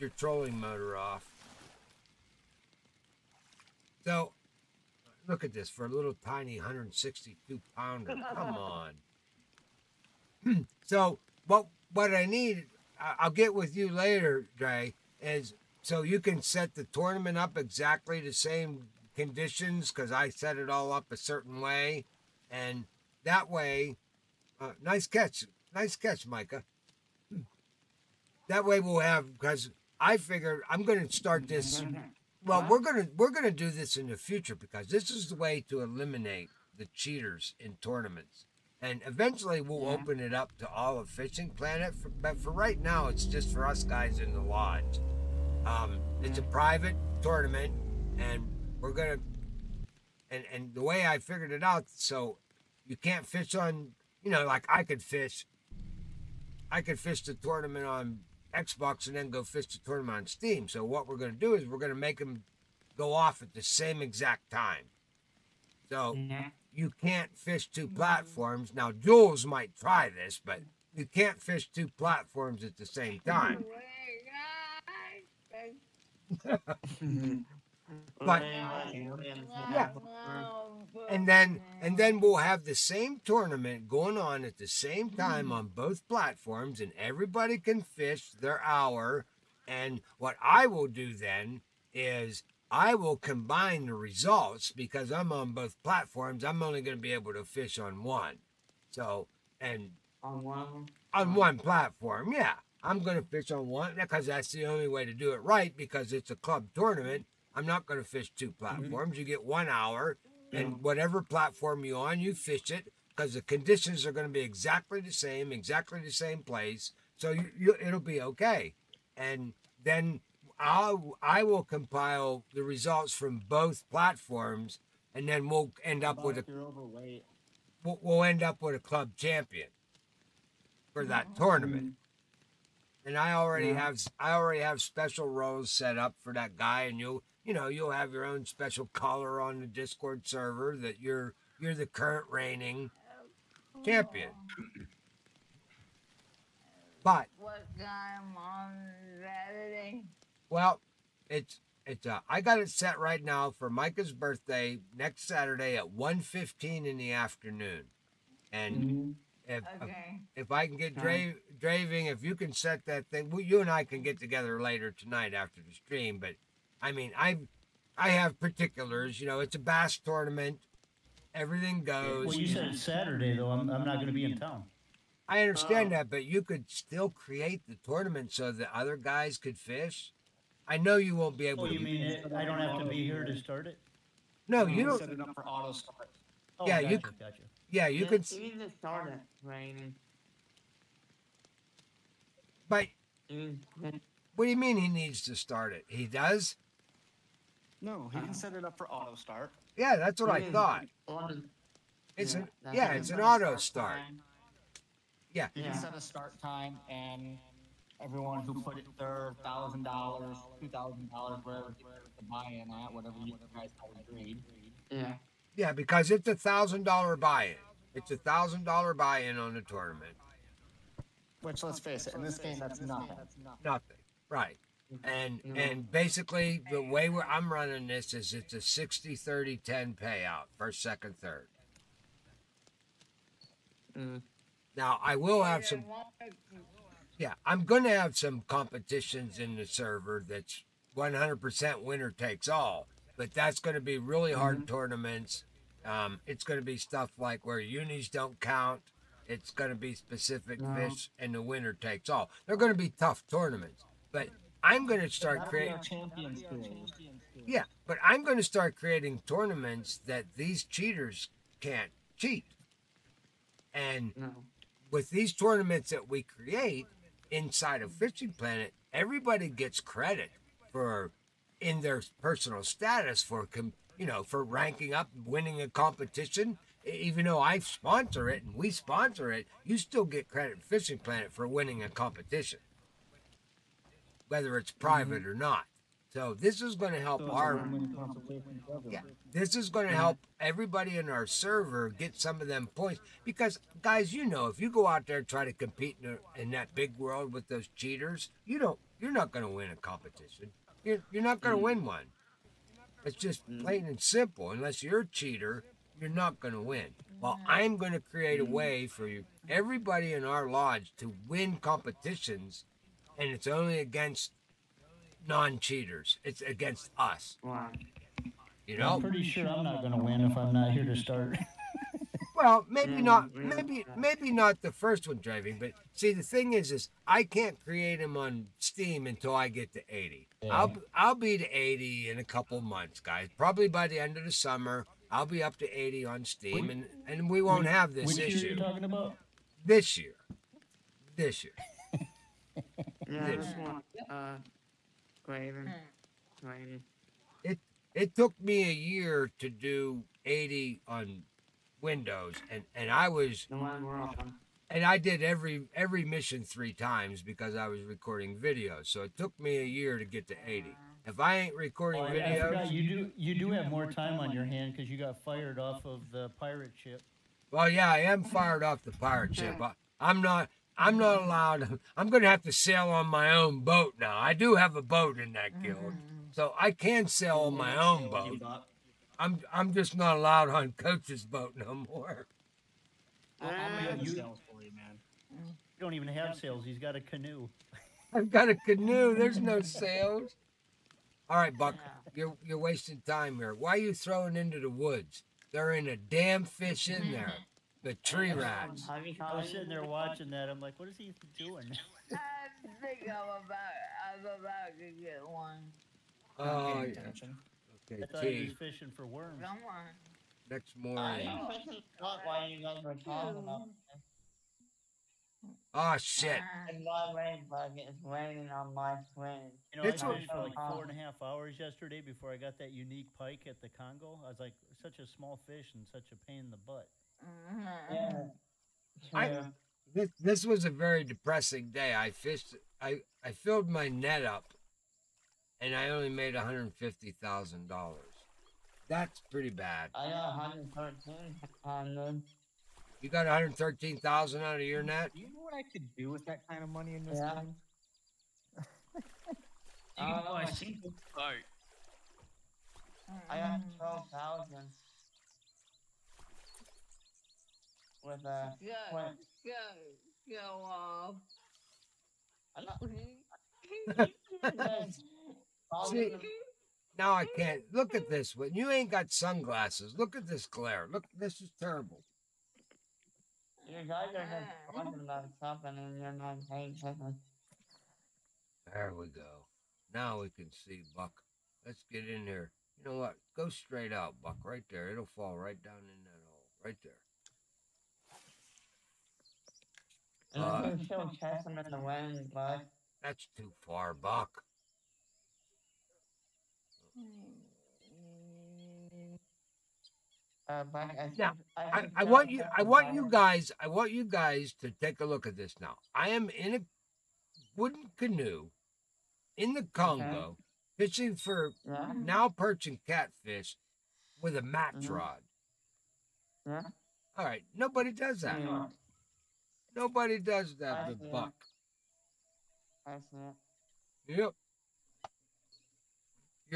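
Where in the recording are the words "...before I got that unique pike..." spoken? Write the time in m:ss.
7:02.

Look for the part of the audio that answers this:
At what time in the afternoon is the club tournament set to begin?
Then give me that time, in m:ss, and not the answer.
2:35.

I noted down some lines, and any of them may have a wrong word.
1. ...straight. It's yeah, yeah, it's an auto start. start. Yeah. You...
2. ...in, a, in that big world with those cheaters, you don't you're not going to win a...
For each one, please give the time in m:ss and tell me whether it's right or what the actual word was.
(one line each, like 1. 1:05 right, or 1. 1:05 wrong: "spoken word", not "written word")
1. 3:20 wrong: "thought", not "straight"
2. 4:56 right.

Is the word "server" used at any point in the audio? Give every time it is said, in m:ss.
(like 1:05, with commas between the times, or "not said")
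2:20, 3:59, 4:51.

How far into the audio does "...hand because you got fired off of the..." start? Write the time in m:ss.
6:04.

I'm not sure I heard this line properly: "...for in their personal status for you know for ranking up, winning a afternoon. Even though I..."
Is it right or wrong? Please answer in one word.
wrong.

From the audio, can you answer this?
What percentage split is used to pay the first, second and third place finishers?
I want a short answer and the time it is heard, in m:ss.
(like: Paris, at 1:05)
60 30 10, at 3:48.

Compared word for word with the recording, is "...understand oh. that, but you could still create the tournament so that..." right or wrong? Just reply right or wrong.
right.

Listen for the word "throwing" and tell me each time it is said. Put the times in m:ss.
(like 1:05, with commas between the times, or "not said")
6:33.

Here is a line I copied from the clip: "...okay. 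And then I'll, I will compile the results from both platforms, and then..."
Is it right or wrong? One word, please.
right.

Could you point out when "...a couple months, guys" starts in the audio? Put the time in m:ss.
5:32.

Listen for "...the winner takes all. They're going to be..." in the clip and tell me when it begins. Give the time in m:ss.
4:11.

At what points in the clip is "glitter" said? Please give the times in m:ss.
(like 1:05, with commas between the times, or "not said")
not said.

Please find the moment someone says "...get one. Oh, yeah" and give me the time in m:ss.
6:45.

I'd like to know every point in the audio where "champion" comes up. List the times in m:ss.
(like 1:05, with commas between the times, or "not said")
2:09, 2:23.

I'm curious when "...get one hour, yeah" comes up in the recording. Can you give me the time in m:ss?
1:49.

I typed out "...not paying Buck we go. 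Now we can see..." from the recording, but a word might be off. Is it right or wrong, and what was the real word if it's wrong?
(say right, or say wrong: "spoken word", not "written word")
wrong: "There", not "Buck".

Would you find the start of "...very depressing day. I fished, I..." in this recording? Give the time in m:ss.
7:10.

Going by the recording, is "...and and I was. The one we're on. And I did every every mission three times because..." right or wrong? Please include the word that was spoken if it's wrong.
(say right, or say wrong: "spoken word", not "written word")
right.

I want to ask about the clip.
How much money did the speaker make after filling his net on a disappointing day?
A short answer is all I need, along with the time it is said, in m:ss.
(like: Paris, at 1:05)
$150,000, at 7:16.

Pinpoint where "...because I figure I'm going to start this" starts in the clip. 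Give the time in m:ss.
0:29.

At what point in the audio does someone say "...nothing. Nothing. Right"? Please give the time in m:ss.
3:42.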